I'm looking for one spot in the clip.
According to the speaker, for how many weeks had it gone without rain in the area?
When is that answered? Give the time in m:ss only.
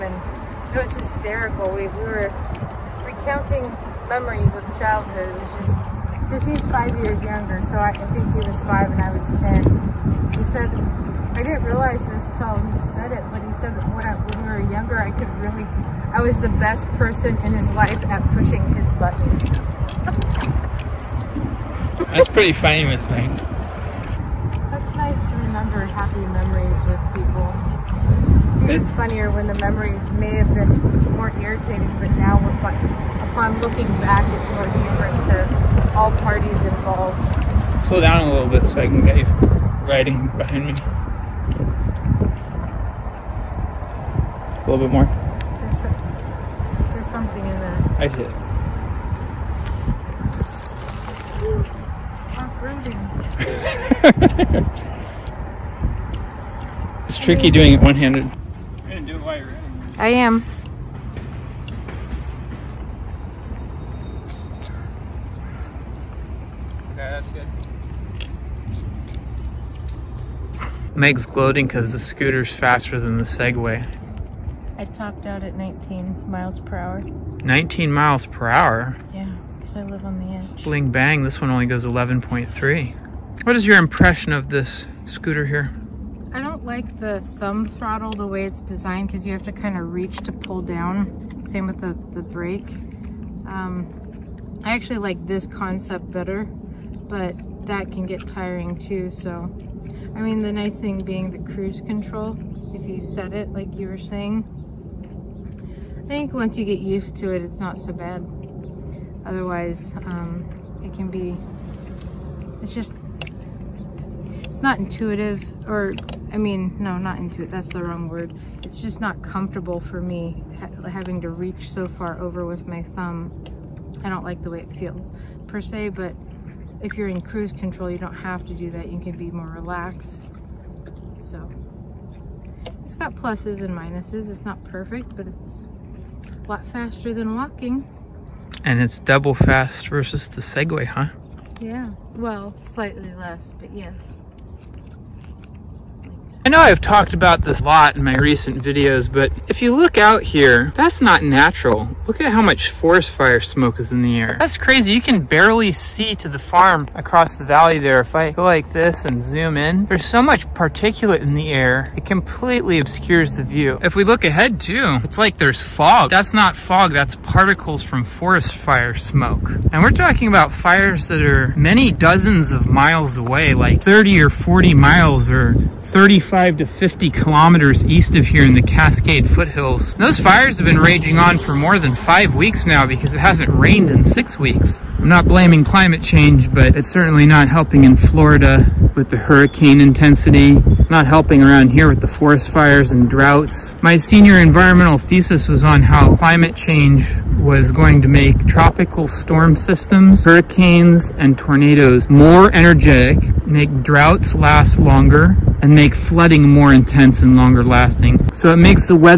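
3:04.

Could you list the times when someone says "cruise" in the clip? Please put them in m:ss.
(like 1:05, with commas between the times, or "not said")
1:41, 2:07.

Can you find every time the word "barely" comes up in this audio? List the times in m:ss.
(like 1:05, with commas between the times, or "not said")
2:35.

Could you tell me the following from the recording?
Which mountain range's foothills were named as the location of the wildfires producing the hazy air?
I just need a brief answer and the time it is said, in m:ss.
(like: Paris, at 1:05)
Cascade, at 2:58.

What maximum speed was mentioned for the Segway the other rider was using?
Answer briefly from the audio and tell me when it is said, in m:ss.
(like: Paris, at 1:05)
11.3, at 1:21.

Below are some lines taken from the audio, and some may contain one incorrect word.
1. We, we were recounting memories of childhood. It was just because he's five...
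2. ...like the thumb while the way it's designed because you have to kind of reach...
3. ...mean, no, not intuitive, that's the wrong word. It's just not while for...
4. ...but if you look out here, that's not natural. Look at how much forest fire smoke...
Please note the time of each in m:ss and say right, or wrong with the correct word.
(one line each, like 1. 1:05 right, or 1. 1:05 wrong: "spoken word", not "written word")
1. 0:01 right
2. 1:26 wrong: "throttle", not "while"
3. 1:56 wrong: "comfortable", not "while"
4. 2:29 right.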